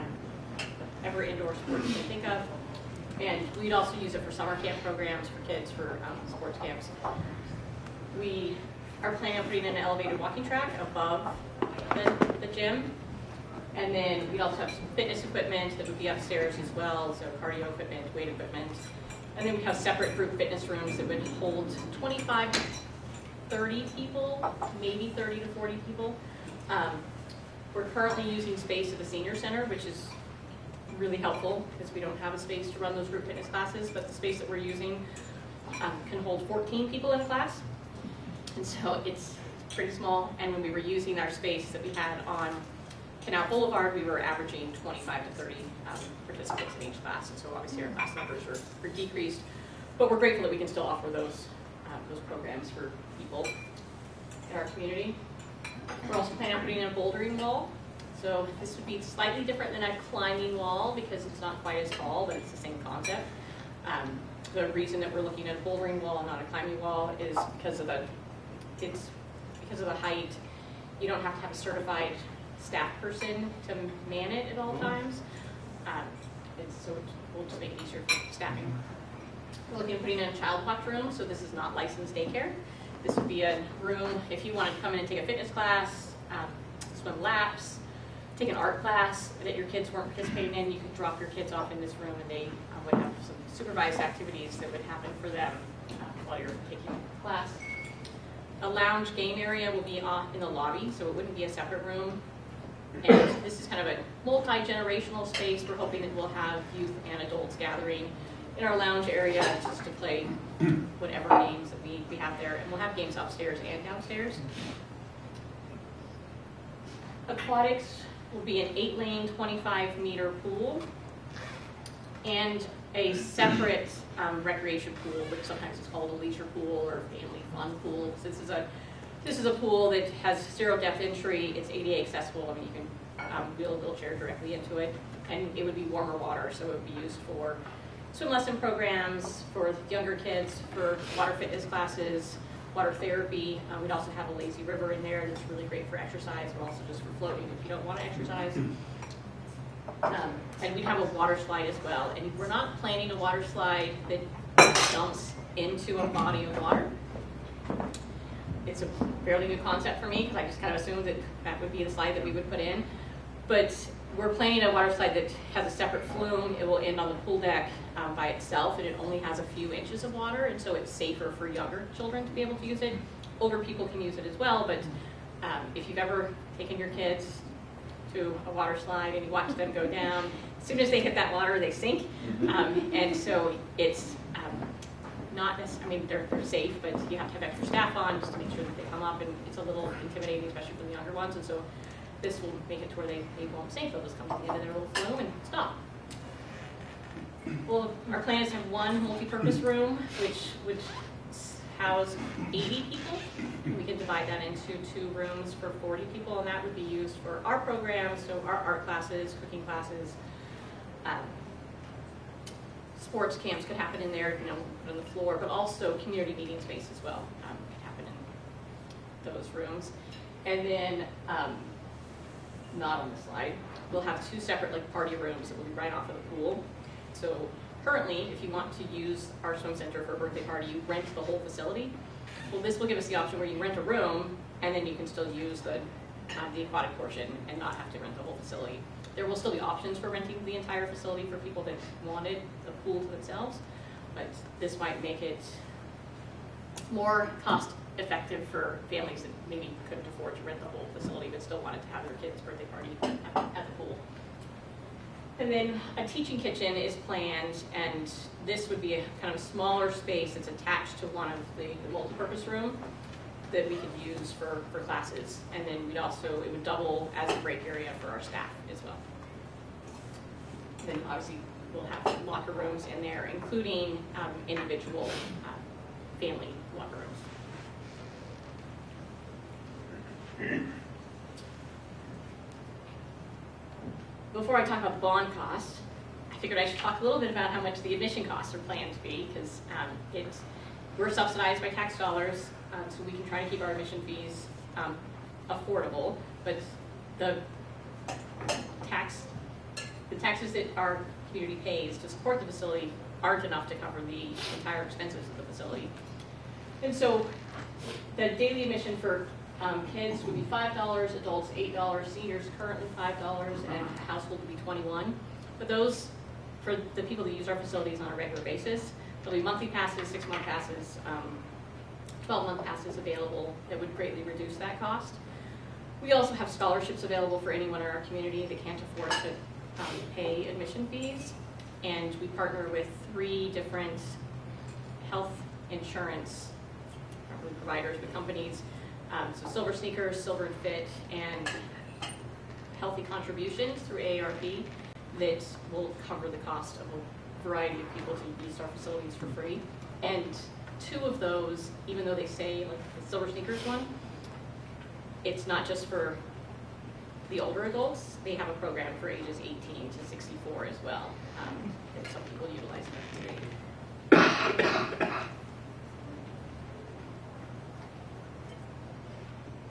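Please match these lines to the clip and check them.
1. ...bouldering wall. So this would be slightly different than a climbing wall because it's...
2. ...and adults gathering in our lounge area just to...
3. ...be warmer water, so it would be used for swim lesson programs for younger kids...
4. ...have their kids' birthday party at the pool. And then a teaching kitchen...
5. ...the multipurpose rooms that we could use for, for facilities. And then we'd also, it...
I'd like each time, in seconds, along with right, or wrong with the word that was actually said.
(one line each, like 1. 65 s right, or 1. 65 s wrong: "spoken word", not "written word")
1. 56 s right
2. 107 s right
3. 135 s right
4. 251 s right
5. 261 s wrong: "classes", not "facilities".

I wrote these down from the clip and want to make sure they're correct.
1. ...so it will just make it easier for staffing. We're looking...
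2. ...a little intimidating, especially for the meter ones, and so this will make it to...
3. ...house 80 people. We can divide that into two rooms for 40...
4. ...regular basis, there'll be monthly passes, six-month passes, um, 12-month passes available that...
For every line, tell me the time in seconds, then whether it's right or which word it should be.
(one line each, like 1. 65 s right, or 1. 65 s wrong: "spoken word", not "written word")
1. 76 s right
2. 189 s wrong: "younger", not "meter"
3. 201 s right
4. 318 s right.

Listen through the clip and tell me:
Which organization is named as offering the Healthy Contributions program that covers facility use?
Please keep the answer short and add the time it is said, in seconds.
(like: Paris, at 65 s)
AARP, at 343 s.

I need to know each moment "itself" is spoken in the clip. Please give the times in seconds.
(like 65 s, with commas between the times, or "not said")
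168 s.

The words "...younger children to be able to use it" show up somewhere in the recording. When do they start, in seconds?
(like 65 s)
171 s.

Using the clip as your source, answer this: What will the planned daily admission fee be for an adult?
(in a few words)
$8.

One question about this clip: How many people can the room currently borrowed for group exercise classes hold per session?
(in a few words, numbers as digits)
14.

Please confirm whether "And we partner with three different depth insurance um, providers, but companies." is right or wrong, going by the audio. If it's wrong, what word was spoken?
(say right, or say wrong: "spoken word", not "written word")
wrong: "health", not "depth".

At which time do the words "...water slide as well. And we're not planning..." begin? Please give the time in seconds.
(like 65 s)
151 s.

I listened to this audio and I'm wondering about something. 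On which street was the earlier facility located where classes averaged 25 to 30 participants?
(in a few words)
Canal Boulevard.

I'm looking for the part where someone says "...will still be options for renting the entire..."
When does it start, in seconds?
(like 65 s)
239 s.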